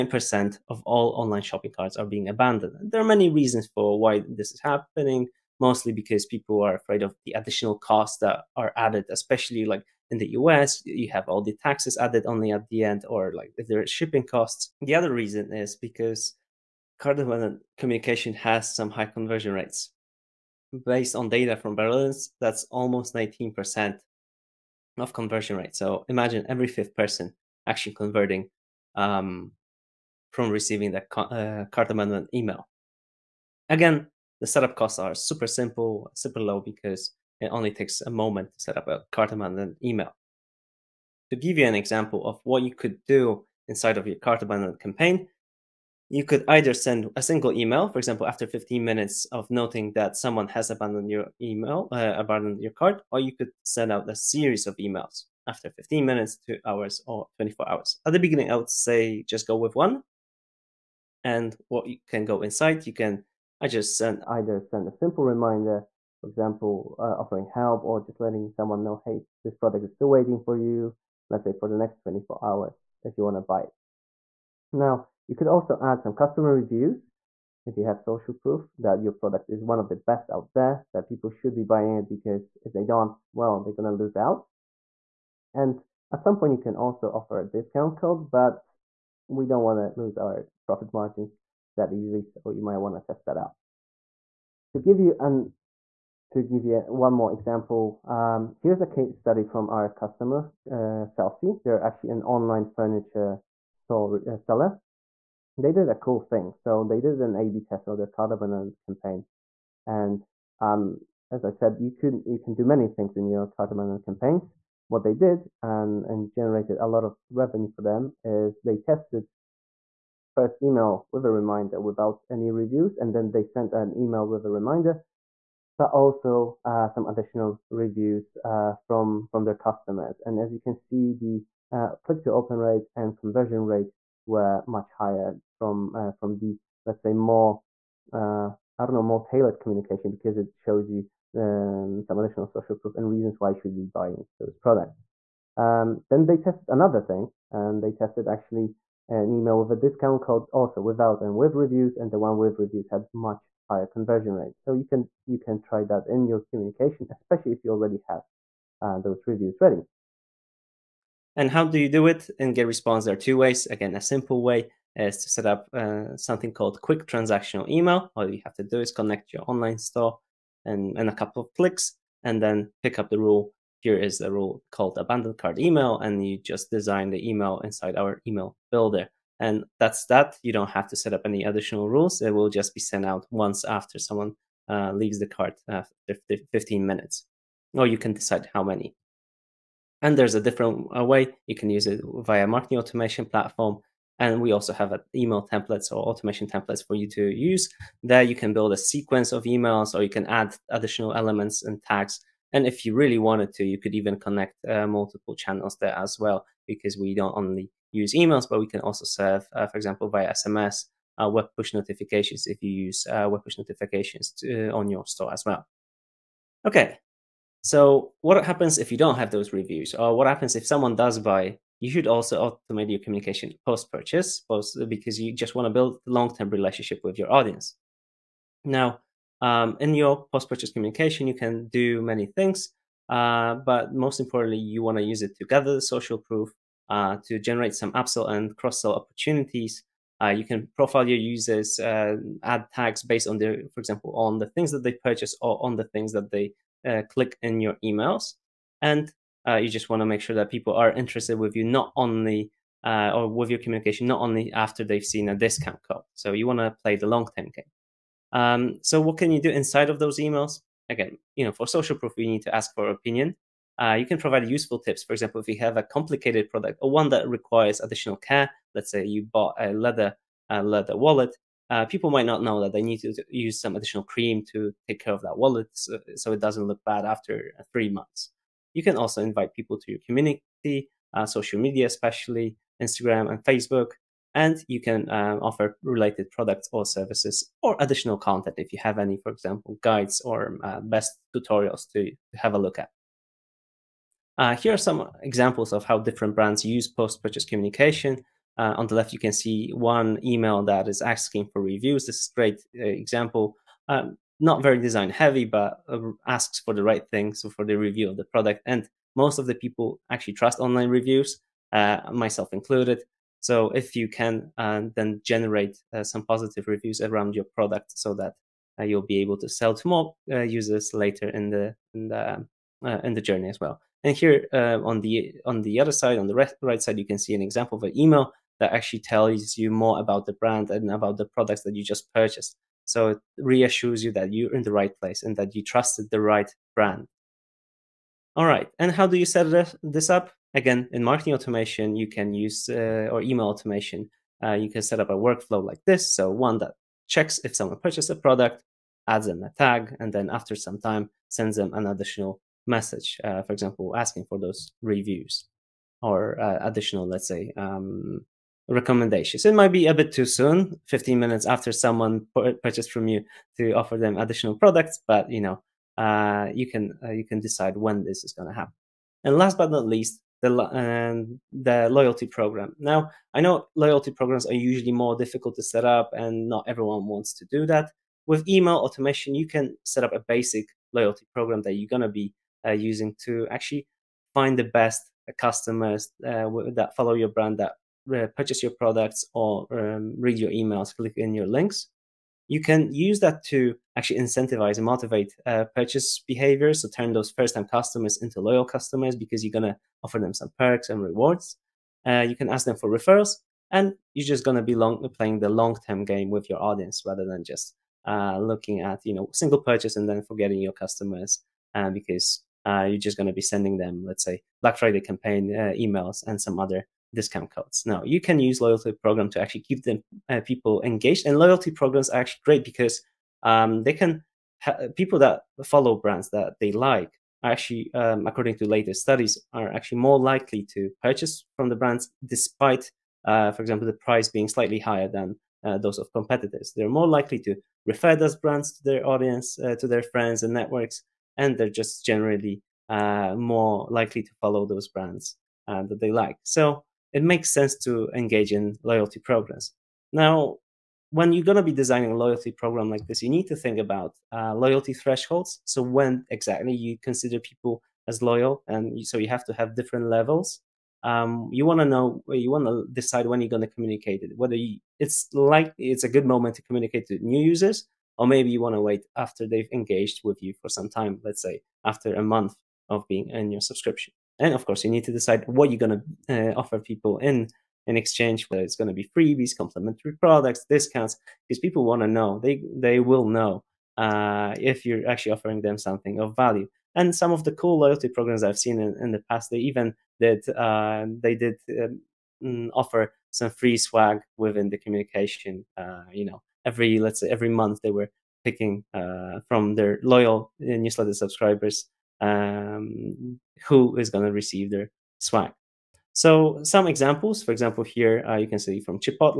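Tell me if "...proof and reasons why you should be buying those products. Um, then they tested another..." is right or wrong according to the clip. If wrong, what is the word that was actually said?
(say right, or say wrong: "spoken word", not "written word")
right.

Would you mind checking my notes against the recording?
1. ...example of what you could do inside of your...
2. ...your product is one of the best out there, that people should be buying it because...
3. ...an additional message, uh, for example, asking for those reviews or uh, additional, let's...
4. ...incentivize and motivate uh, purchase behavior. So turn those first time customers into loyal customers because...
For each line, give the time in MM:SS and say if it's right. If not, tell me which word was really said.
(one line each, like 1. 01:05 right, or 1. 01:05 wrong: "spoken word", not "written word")
1. 00:41 right
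2. 01:19 right
3. 05:51 right
4. 06:34 right.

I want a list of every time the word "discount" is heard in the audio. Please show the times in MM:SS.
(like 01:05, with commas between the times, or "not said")
01:27, 02:29, 04:15, 06:57, 08:00.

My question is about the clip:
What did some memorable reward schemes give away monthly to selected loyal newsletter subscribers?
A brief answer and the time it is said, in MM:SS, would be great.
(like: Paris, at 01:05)
free swag, at 08:13.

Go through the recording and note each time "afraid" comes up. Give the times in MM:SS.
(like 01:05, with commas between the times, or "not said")
00:06.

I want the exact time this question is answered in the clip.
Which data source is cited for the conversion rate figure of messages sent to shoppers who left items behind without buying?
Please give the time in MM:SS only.
00:21.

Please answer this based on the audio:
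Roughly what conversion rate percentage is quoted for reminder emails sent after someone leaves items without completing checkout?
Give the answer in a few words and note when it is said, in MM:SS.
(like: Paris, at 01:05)
19%, at 00:23.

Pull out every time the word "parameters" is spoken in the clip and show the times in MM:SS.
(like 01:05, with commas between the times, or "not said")
not said.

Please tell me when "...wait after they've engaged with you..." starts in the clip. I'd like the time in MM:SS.
07:48.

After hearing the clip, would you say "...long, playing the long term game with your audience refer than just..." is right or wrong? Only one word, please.
wrong.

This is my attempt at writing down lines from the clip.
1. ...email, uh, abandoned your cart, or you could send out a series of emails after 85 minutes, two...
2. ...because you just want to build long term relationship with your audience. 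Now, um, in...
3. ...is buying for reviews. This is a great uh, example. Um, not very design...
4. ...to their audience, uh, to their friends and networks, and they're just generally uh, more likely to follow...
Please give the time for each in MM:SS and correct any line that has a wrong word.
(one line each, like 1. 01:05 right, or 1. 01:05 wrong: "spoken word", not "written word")
1. 00:51 wrong: "15", not "85"
2. 03:44 right
3. 05:00 wrong: "asking", not "buying"
4. 07:18 right.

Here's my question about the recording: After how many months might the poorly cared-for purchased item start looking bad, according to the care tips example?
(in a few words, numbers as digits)
3.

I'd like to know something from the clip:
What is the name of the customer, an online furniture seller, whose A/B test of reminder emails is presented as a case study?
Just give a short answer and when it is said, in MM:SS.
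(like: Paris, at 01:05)
Celsi, at 01:41.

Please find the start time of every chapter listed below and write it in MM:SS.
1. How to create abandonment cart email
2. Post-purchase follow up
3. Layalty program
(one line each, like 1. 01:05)
1. 02:39
2. 03:35
3. 06:05.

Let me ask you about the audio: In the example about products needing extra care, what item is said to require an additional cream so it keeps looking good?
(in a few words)
leather wallet.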